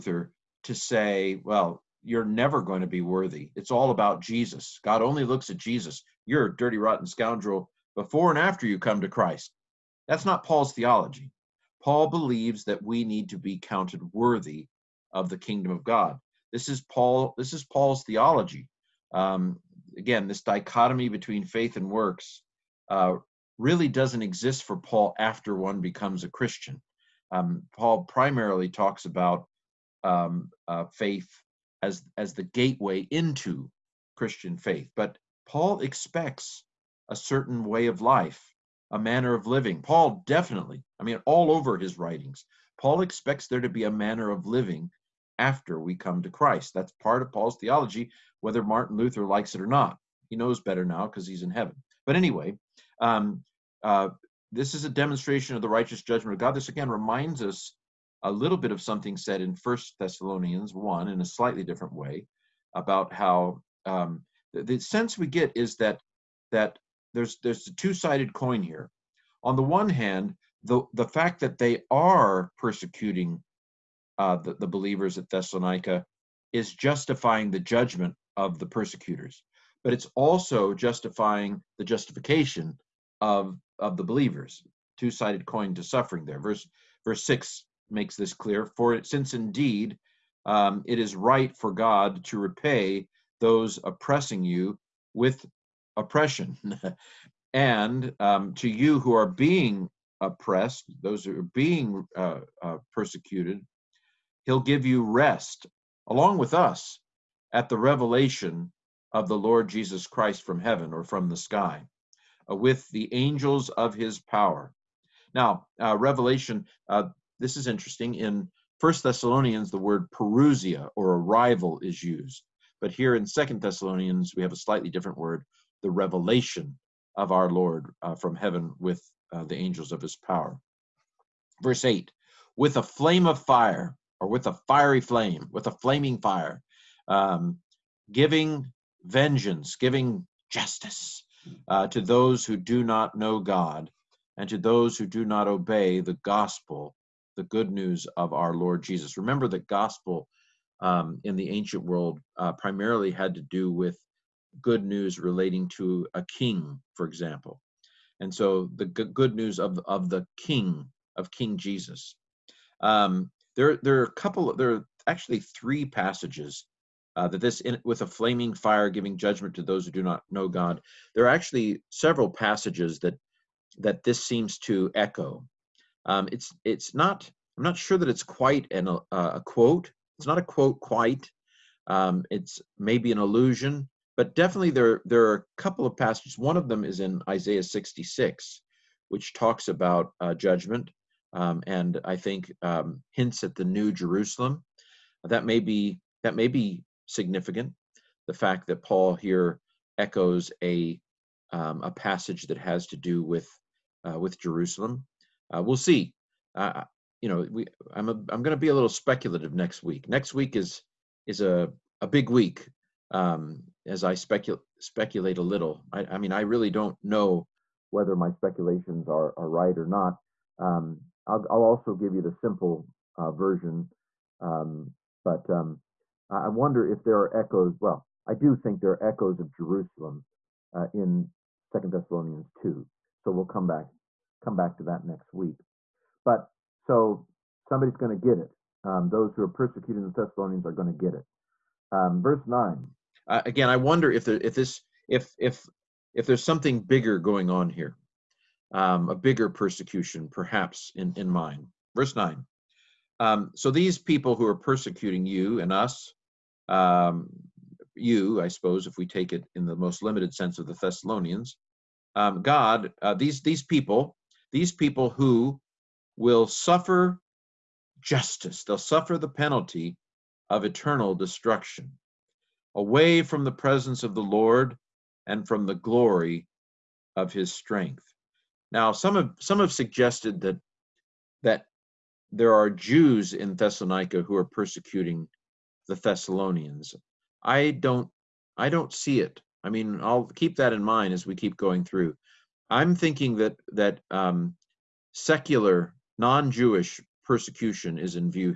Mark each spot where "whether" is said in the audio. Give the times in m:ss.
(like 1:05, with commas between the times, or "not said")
0:48, 3:37.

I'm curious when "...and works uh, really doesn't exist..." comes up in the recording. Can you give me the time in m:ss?
0:21.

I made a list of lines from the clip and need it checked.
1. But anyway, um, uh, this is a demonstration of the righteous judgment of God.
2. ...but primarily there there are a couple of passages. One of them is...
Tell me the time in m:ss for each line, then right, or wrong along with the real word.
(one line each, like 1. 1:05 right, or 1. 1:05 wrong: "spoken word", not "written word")
1. 0:52 right
2. 3:04 wrong: "definitely", not "primarily".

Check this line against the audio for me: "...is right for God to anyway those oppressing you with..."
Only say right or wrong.
wrong.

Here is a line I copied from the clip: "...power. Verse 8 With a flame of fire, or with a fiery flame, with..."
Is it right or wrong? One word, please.
right.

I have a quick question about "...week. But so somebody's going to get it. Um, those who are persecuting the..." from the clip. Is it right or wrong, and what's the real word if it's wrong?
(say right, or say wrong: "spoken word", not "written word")
right.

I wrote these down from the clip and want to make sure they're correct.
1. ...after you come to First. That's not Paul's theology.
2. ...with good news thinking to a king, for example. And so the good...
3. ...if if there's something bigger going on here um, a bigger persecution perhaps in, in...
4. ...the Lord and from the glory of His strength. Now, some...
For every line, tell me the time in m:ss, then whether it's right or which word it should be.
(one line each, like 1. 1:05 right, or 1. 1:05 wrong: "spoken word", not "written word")
1. 0:08 wrong: "Christ", not "First"
2. 2:33 wrong: "relating", not "thinking"
3. 4:05 right
4. 4:34 right.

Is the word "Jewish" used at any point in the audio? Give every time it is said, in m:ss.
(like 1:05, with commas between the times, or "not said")
4:56.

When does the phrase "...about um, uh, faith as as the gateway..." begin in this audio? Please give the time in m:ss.
0:29.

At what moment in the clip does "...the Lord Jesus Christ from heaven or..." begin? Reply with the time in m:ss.
1:49.